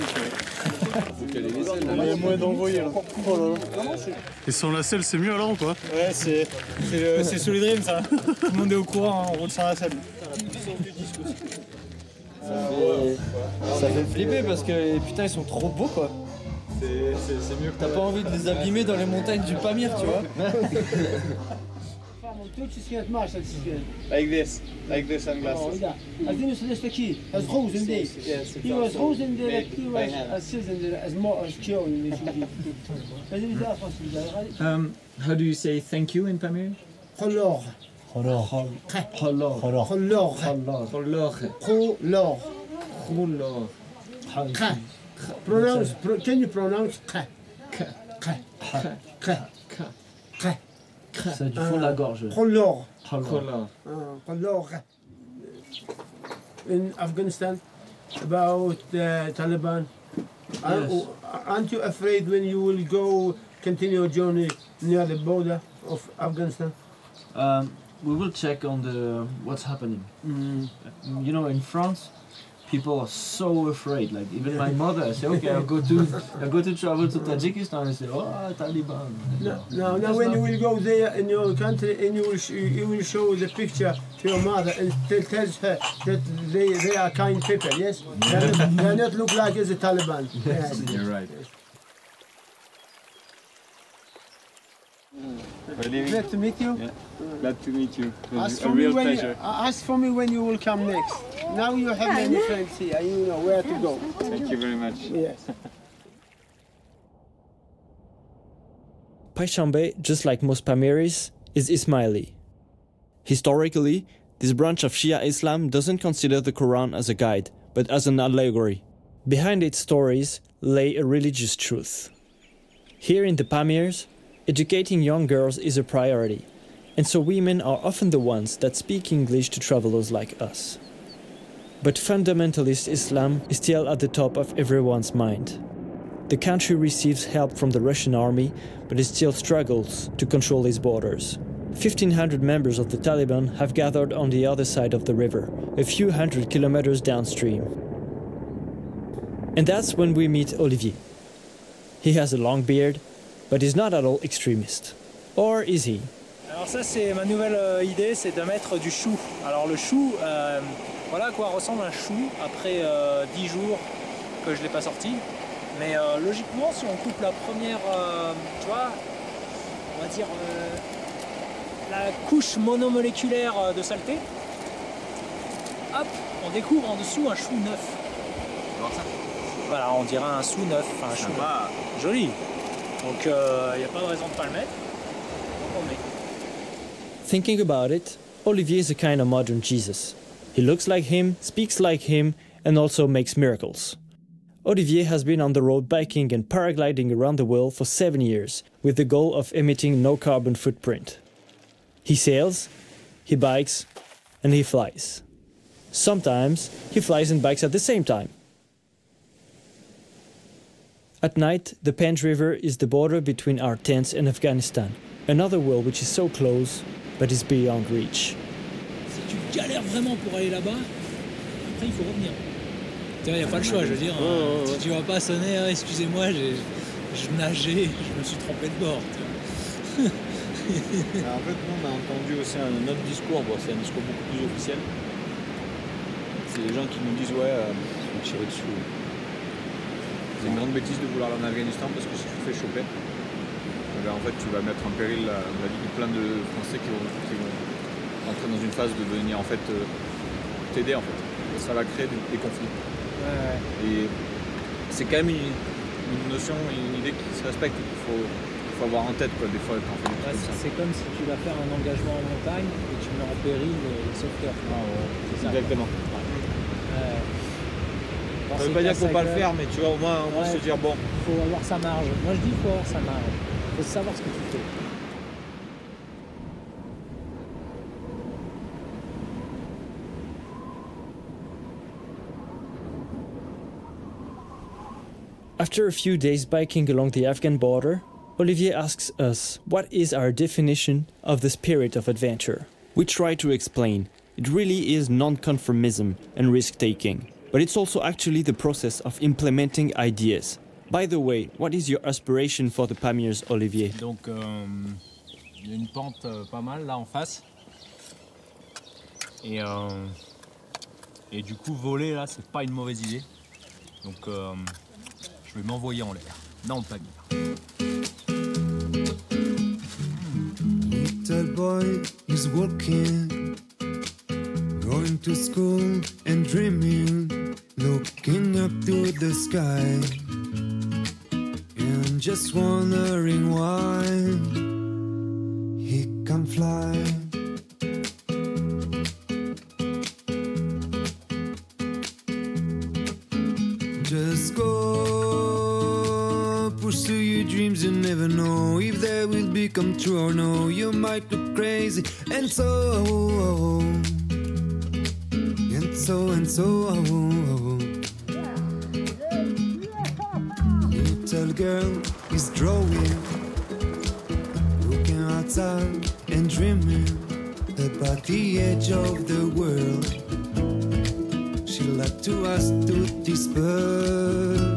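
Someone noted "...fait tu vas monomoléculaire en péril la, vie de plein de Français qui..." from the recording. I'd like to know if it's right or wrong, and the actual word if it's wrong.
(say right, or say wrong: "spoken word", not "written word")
wrong: "mettre", not "monomoléculaire".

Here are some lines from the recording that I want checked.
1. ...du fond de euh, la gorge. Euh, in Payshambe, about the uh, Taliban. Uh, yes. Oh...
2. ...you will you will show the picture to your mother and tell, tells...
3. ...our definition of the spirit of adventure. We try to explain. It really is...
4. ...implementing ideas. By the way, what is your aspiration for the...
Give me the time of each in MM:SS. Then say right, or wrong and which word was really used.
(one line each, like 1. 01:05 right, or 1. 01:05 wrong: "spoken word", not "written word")
1. 00:51 wrong: "Afghanistan", not "Payshambe"
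2. 01:22 right
3. 04:50 right
4. 04:59 right.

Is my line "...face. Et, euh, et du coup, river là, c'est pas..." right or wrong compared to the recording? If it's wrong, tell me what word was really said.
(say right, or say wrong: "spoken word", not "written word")
wrong: "voler", not "river".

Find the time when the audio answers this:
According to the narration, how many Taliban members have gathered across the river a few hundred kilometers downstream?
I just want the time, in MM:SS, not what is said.
02:21.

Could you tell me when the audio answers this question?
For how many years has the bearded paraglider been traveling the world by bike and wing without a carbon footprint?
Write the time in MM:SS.
03:17.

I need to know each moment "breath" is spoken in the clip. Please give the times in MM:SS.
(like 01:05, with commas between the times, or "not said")
not said.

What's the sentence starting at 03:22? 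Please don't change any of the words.
He sails, he bikes, and he flies.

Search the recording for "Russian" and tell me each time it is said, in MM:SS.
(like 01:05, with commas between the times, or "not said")
02:17.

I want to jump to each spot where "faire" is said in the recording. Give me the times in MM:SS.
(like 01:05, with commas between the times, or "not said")
04:21, 04:29.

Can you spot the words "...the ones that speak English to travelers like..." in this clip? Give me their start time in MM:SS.
02:08.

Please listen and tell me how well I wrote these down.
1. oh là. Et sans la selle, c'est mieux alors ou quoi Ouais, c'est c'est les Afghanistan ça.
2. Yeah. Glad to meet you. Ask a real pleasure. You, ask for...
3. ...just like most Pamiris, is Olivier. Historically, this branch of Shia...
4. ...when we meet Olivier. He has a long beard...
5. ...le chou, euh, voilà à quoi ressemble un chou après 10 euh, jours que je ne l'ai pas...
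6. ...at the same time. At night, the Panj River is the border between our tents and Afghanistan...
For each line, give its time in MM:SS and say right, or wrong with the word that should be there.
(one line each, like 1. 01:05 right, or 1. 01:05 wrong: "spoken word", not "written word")
1. 00:03 wrong: "Dream", not "Afghanistan"
2. 01:36 right
3. 01:50 wrong: "Ismaili", not "Olivier"
4. 02:29 right
5. 02:39 right
6. 03:27 right.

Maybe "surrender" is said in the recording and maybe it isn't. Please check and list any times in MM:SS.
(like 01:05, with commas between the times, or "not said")
not said.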